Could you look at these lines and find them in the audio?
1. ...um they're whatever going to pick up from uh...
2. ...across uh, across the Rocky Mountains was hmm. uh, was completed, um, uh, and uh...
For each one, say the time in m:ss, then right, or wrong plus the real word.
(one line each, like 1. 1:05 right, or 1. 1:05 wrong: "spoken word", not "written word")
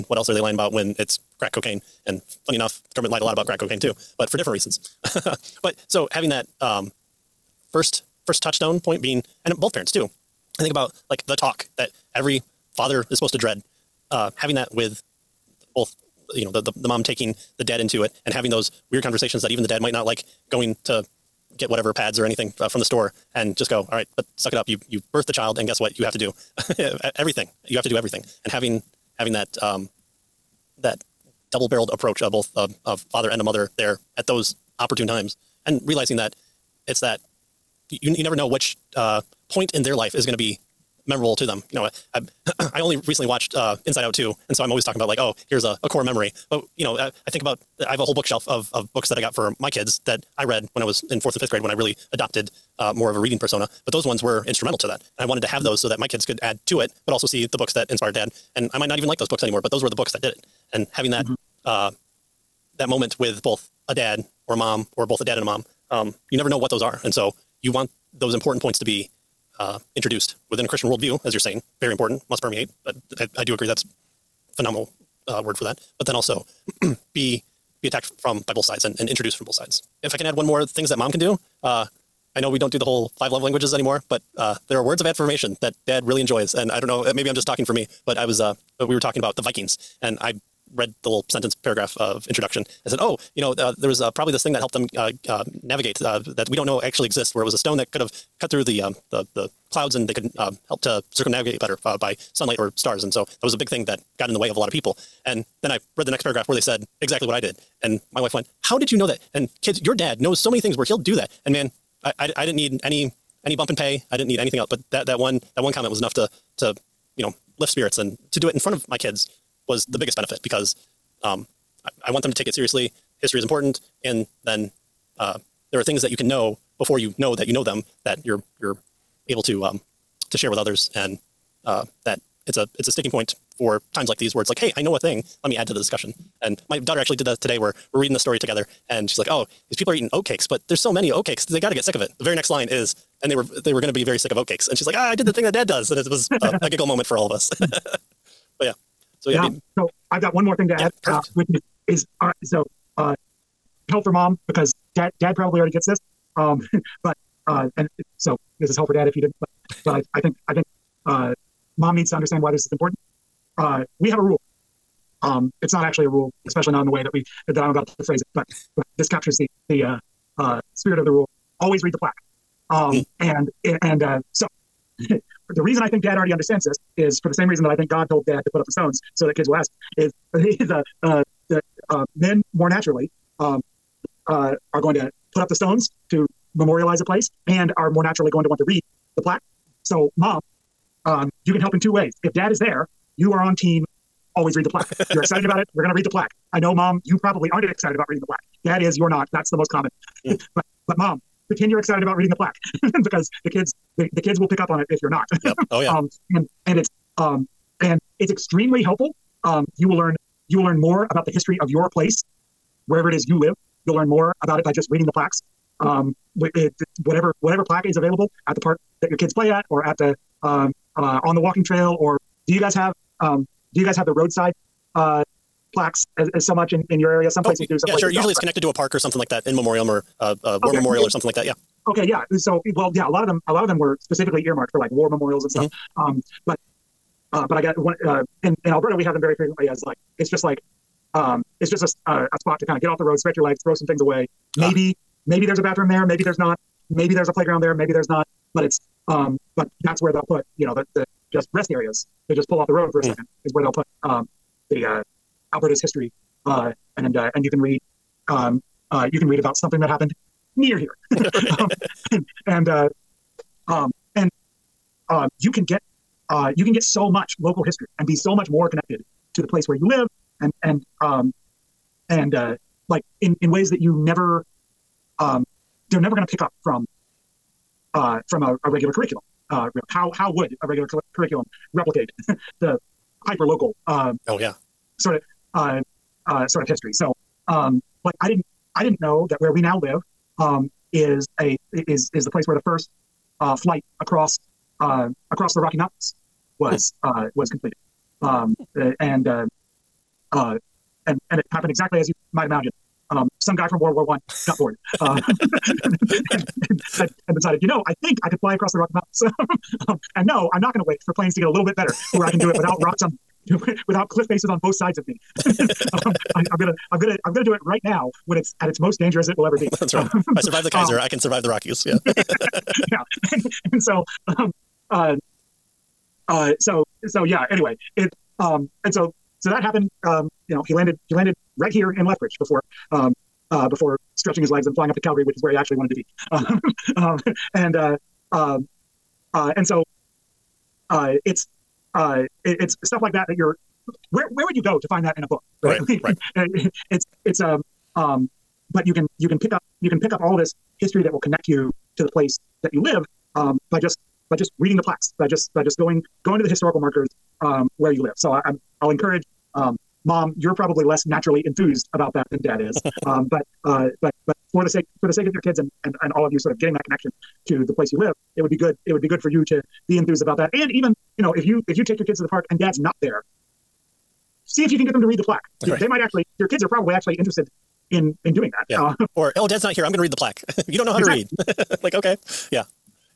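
1. 4:35 wrong: "never", not "whatever"
2. 4:54 right.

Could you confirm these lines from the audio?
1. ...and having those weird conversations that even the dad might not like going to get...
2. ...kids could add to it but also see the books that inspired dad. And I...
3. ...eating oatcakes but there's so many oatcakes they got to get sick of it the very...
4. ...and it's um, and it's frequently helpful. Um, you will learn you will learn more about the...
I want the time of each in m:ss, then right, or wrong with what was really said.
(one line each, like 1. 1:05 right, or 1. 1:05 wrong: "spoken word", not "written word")
1. 0:18 right
2. 0:56 right
3. 2:19 right
4. 3:26 wrong: "extremely", not "frequently".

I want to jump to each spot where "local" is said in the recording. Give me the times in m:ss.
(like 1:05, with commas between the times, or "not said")
4:27, 4:43.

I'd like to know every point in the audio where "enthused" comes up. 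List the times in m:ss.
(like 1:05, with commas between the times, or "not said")
6:01, 6:09.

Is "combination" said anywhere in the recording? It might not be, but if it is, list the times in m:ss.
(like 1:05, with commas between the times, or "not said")
not said.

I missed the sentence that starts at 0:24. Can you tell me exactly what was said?
You you birthed the child, and guess what?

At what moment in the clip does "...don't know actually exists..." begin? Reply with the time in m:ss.
1:36.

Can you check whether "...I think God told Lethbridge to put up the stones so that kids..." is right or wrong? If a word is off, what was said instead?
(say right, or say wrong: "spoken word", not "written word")
wrong: "Dad", not "Lethbridge".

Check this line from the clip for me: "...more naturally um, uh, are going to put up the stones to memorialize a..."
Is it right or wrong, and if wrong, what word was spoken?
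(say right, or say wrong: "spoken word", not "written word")
right.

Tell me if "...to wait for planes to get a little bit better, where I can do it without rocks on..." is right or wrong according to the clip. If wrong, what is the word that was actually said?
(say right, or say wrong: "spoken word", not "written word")
right.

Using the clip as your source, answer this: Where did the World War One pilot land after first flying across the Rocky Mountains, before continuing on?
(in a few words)
Lethbridge.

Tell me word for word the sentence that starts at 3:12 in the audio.
If dad is there, you are on team.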